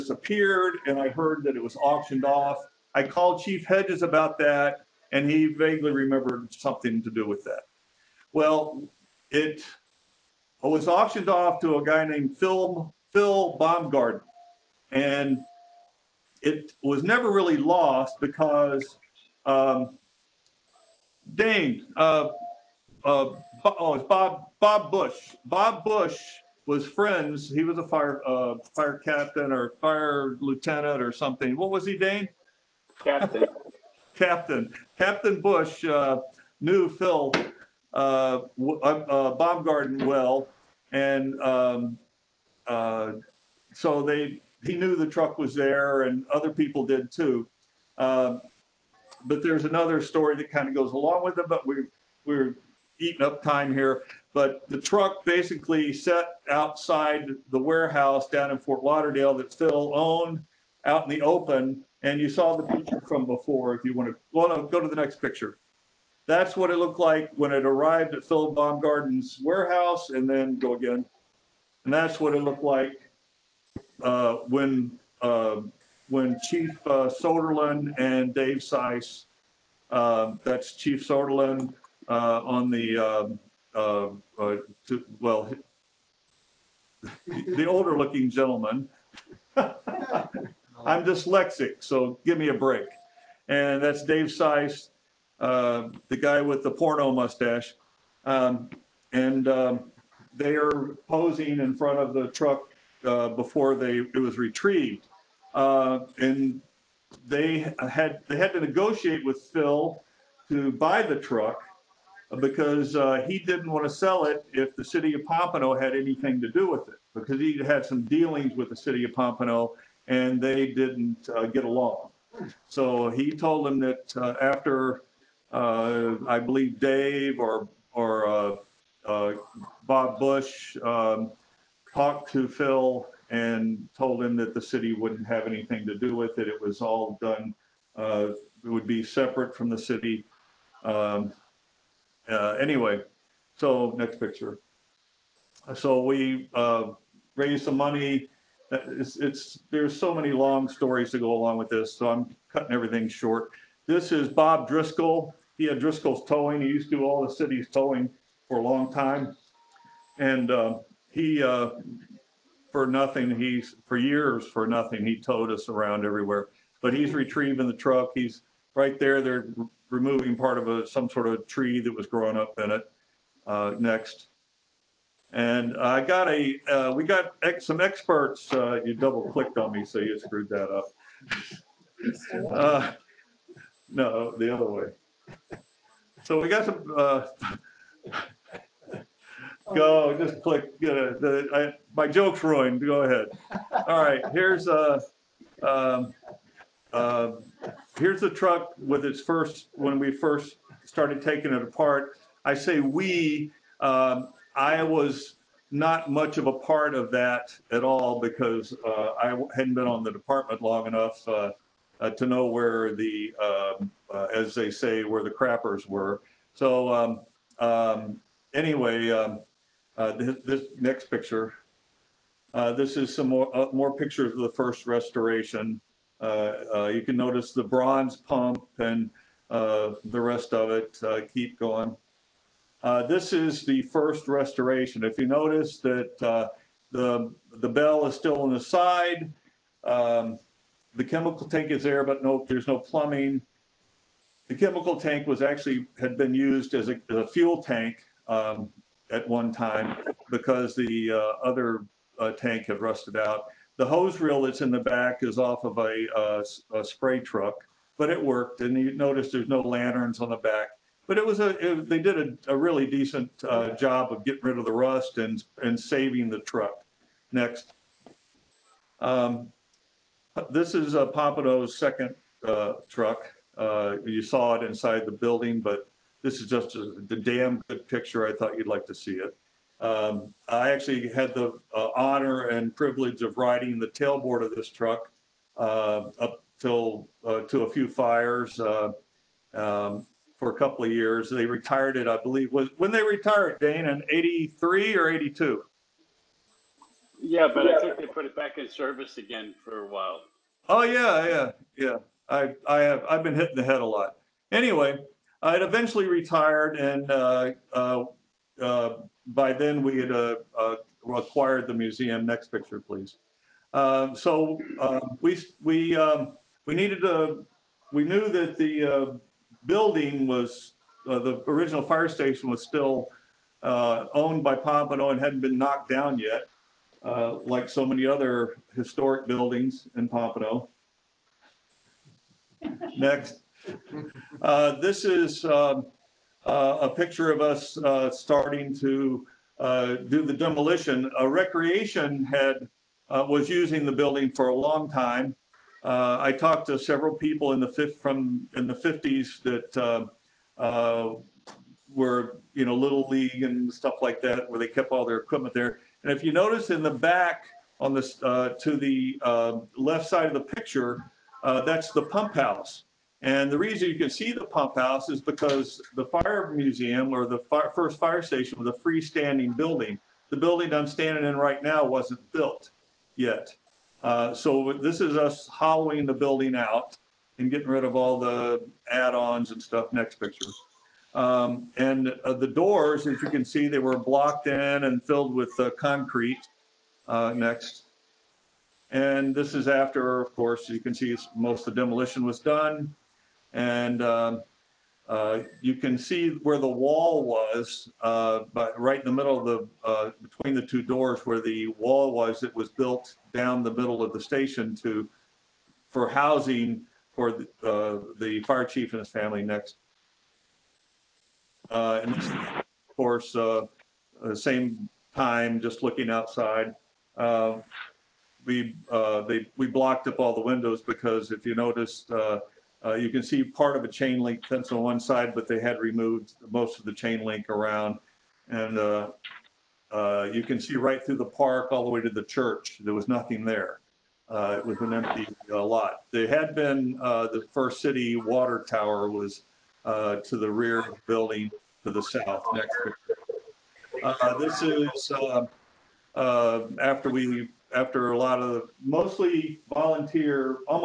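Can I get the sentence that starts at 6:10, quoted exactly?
The building I'm standing in right now wasn't built yet.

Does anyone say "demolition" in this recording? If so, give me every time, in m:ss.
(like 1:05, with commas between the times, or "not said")
5:40, 6:31.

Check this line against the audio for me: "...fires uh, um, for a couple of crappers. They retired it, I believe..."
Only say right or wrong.
wrong.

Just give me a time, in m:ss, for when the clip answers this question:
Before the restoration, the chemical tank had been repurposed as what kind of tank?
4:07.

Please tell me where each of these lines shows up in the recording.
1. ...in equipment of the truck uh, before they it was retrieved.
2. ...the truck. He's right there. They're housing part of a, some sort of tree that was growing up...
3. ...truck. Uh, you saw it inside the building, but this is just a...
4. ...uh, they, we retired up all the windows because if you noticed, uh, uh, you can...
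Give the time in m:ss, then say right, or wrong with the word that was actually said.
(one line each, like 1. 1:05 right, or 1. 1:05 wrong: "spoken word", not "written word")
1. 1:41 wrong: "front", not "equipment"
2. 2:47 wrong: "removing", not "housing"
3. 4:32 right
4. 6:58 wrong: "blocked", not "retired".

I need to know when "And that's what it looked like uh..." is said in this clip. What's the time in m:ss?
1:11.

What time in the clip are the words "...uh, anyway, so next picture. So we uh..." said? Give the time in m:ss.
2:22.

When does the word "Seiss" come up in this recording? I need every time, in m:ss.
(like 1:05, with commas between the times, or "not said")
1:18, 1:34.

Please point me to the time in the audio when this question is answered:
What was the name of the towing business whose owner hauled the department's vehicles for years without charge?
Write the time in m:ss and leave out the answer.
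2:35.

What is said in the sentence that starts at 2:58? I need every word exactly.
Uh, you double clicked on me, so you screwed that up.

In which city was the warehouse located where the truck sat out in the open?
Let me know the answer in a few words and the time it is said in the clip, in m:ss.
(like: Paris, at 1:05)
Fort Lauderdale, at 0:58.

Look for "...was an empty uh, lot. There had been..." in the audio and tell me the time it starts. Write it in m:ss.
7:14.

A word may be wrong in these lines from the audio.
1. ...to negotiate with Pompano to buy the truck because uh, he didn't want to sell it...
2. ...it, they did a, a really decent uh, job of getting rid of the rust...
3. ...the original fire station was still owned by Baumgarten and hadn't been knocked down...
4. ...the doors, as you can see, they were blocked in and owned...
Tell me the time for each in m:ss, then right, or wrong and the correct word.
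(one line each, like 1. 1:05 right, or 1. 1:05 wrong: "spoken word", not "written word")
1. 1:48 wrong: "Phil", not "Pompano"
2. 4:21 right
3. 5:21 wrong: "Pompano", not "Baumgarten"
4. 6:22 wrong: "filled", not "owned".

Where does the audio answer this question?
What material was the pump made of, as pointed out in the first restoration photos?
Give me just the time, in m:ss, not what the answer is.
3:47.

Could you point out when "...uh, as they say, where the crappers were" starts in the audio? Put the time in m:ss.
3:34.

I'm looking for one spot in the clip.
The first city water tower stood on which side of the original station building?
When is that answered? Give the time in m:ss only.
7:22.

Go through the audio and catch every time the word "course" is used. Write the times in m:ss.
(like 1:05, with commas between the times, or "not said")
6:30, 6:52.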